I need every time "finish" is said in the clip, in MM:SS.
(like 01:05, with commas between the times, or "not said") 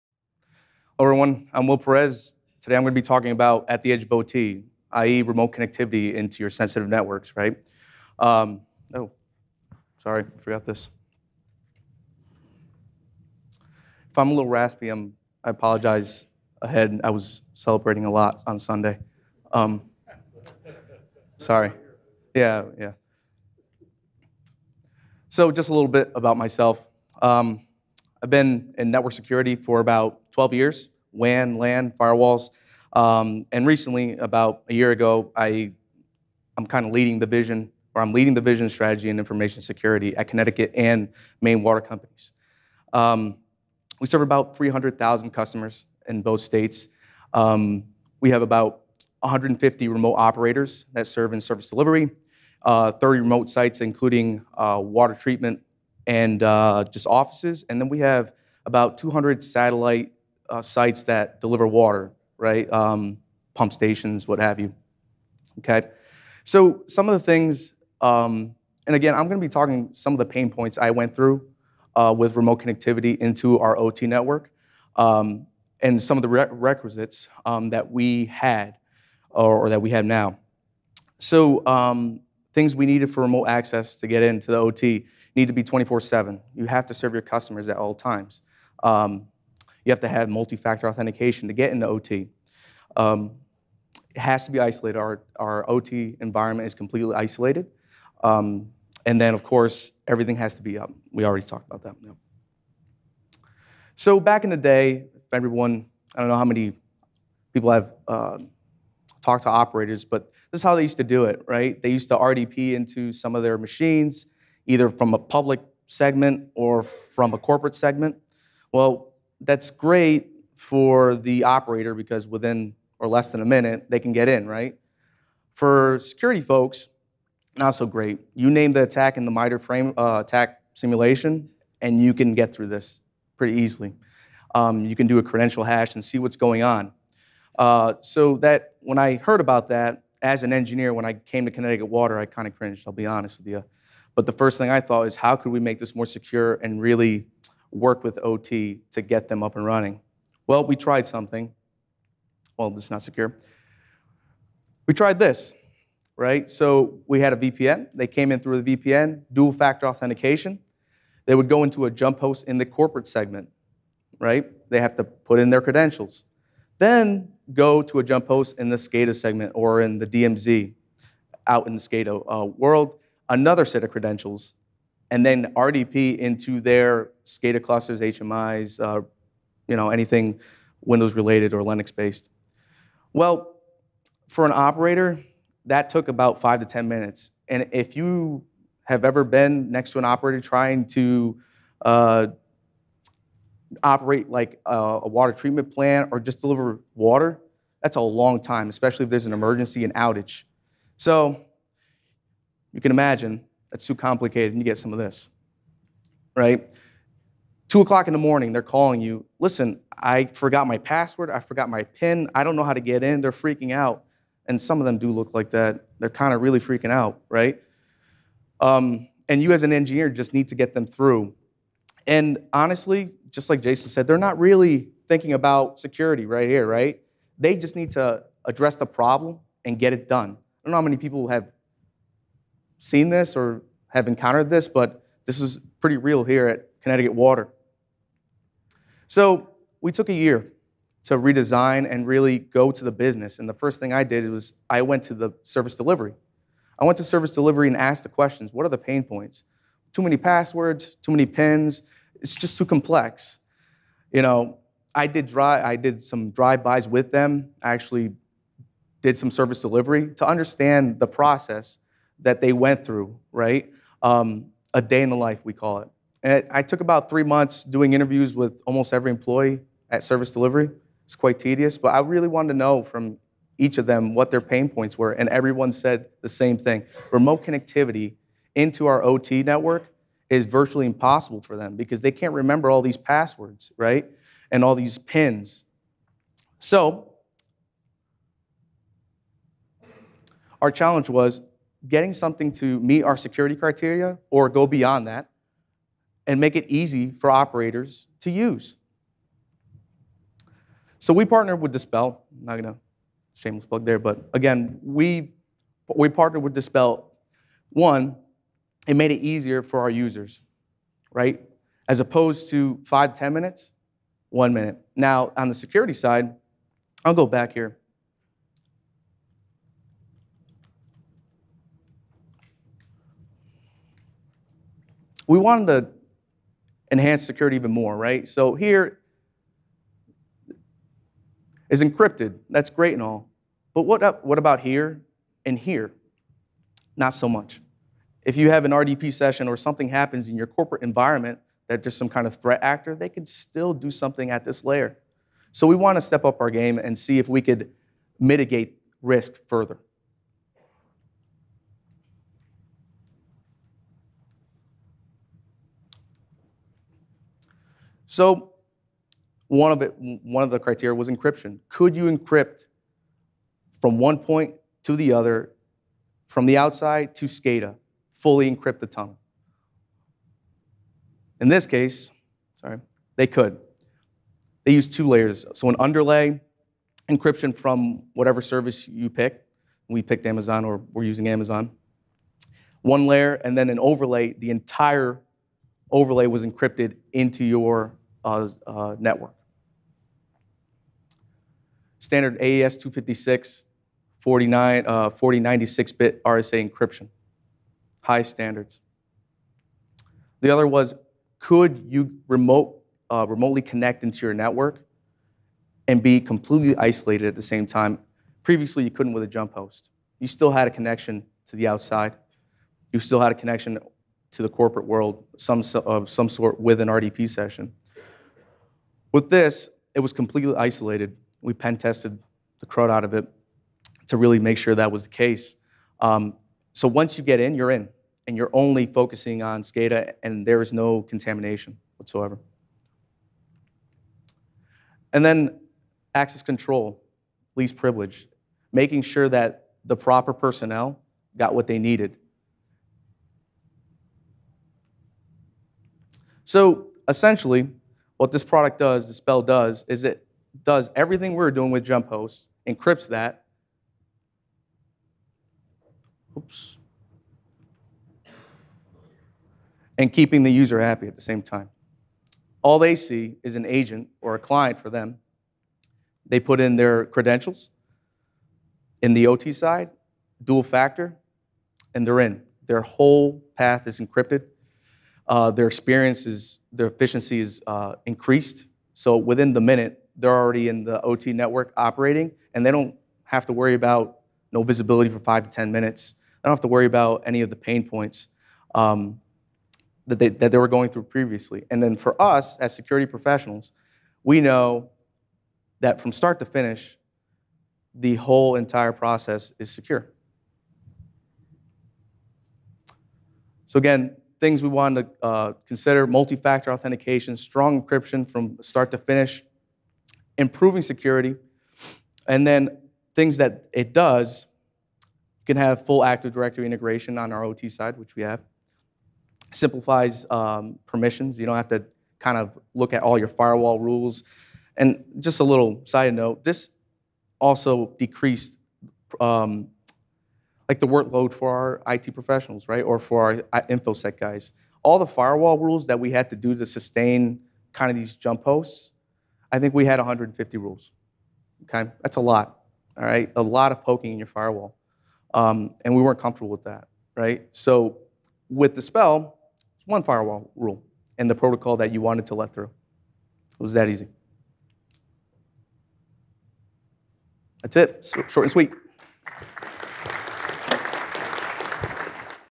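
08:16, 08:28.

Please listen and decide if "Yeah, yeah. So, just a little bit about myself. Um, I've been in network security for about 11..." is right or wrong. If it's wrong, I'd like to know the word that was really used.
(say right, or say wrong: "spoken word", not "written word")
wrong: "12", not "11".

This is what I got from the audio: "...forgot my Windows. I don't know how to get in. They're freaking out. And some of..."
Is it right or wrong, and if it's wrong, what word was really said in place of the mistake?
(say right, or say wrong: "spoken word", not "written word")
wrong: "PIN", not "Windows".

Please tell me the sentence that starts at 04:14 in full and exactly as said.
You know, I did dry, I did some drive-bys with them.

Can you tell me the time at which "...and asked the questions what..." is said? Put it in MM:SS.
04:07.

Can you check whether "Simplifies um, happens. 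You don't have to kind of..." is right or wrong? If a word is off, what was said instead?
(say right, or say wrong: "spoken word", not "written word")
wrong: "permissions", not "happens".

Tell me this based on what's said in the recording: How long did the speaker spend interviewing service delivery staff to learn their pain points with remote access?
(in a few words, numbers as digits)
3 months.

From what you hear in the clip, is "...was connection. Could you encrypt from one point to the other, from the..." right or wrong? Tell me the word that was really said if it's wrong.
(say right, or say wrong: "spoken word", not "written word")
wrong: "encryption", not "connection".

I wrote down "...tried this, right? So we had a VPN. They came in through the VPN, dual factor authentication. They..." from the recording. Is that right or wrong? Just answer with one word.
right.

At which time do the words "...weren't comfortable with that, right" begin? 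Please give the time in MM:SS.
09:06.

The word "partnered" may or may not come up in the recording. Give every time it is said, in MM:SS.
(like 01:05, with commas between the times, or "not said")
05:01, 05:06.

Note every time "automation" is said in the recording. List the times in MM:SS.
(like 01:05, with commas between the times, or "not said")
not said.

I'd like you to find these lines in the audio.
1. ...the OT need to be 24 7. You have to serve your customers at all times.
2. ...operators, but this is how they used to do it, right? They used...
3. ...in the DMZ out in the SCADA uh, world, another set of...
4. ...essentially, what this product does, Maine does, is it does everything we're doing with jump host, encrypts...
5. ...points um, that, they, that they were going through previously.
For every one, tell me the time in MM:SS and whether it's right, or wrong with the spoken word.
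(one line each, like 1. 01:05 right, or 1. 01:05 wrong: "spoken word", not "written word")
1. 01:24 right
2. 01:49 right
3. 02:49 right
4. 07:27 wrong: "Dispel", not "Maine"
5. 08:07 right.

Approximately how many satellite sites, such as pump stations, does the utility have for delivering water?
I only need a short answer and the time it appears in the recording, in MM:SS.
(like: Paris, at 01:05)
200, at 00:58.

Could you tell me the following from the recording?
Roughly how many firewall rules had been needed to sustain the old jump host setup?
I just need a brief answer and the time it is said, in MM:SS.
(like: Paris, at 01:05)
150, at 08:59.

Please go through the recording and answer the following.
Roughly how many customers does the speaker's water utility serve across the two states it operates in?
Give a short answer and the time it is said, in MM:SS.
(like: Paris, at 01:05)
300,000, at 00:44.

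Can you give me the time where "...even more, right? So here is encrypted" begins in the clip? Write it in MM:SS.
05:27.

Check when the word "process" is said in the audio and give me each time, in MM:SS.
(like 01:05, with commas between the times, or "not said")
04:21, 08:18.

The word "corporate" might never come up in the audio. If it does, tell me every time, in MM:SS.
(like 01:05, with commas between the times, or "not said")
01:57, 02:42, 05:40, 06:54.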